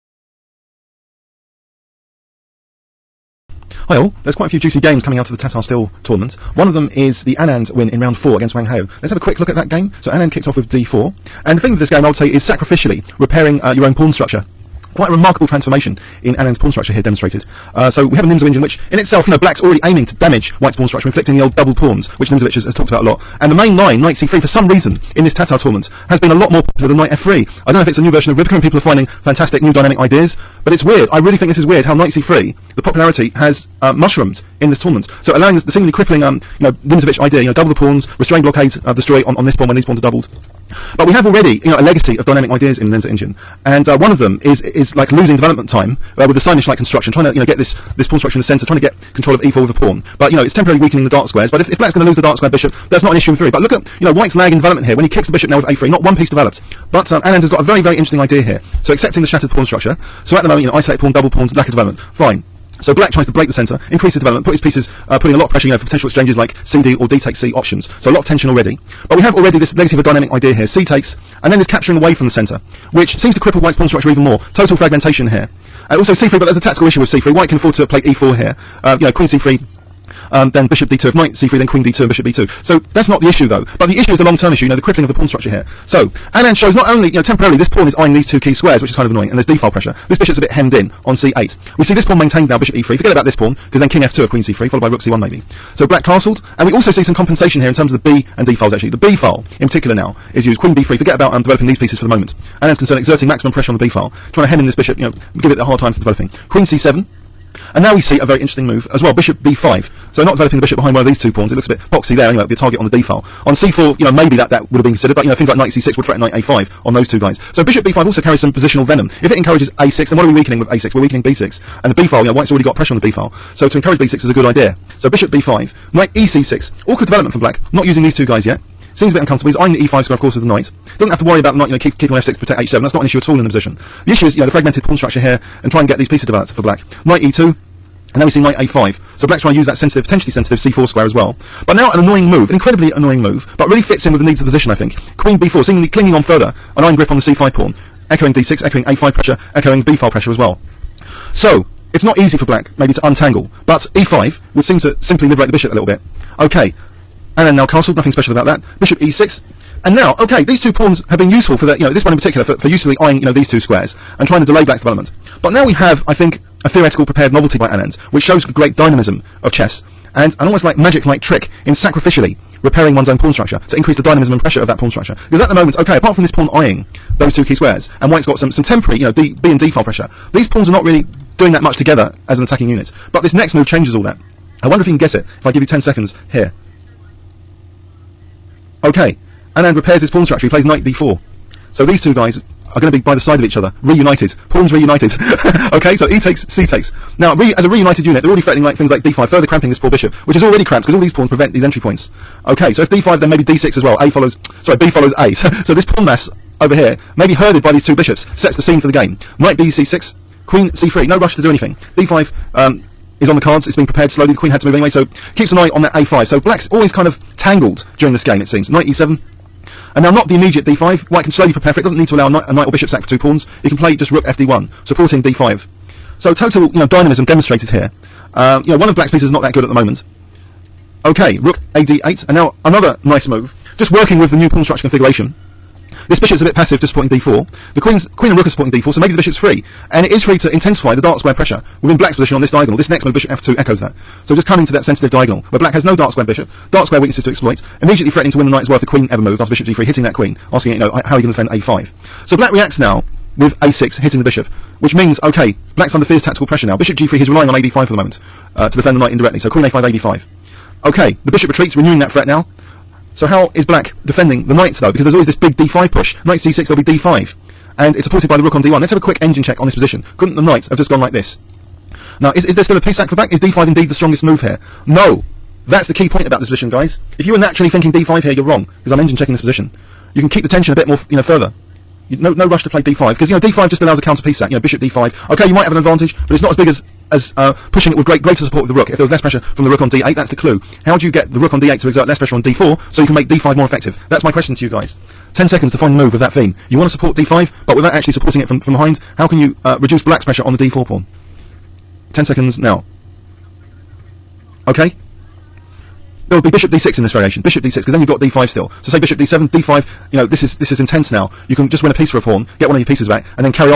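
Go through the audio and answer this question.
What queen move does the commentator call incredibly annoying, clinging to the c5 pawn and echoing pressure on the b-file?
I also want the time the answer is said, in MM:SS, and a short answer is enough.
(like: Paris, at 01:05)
Queen b4, at 02:25.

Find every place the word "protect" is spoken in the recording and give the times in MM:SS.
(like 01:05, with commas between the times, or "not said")
02:12.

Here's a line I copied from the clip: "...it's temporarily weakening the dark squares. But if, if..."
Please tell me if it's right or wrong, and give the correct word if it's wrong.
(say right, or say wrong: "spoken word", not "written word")
right.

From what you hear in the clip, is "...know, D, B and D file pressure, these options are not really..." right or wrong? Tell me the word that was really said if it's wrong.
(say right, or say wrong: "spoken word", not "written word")
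wrong: "pawns", not "options".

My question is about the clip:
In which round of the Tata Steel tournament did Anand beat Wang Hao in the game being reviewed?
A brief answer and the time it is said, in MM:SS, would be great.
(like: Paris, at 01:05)
Round 4, at 00:08.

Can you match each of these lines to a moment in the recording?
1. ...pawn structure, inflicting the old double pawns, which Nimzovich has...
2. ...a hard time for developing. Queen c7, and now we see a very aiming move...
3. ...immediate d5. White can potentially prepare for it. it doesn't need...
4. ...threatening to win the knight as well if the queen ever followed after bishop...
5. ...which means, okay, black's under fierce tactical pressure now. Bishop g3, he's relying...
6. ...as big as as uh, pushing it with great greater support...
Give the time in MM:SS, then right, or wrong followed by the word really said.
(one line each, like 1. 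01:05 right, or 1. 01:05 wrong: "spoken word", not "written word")
1. 00:20 right
2. 01:45 wrong: "interesting", not "aiming"
3. 03:40 wrong: "slowly", not "potentially"
4. 04:08 wrong: "moved", not "followed"
5. 04:14 right
6. 04:46 right.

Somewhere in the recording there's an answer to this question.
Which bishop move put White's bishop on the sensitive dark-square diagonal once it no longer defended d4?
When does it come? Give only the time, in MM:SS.
04:03.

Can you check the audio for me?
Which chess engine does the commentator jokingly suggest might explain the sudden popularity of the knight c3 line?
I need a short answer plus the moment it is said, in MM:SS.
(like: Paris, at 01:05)
Rybka, at 00:28.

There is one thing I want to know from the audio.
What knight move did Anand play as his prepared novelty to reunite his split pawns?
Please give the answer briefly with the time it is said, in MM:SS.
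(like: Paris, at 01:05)
Knight d4, at 03:10.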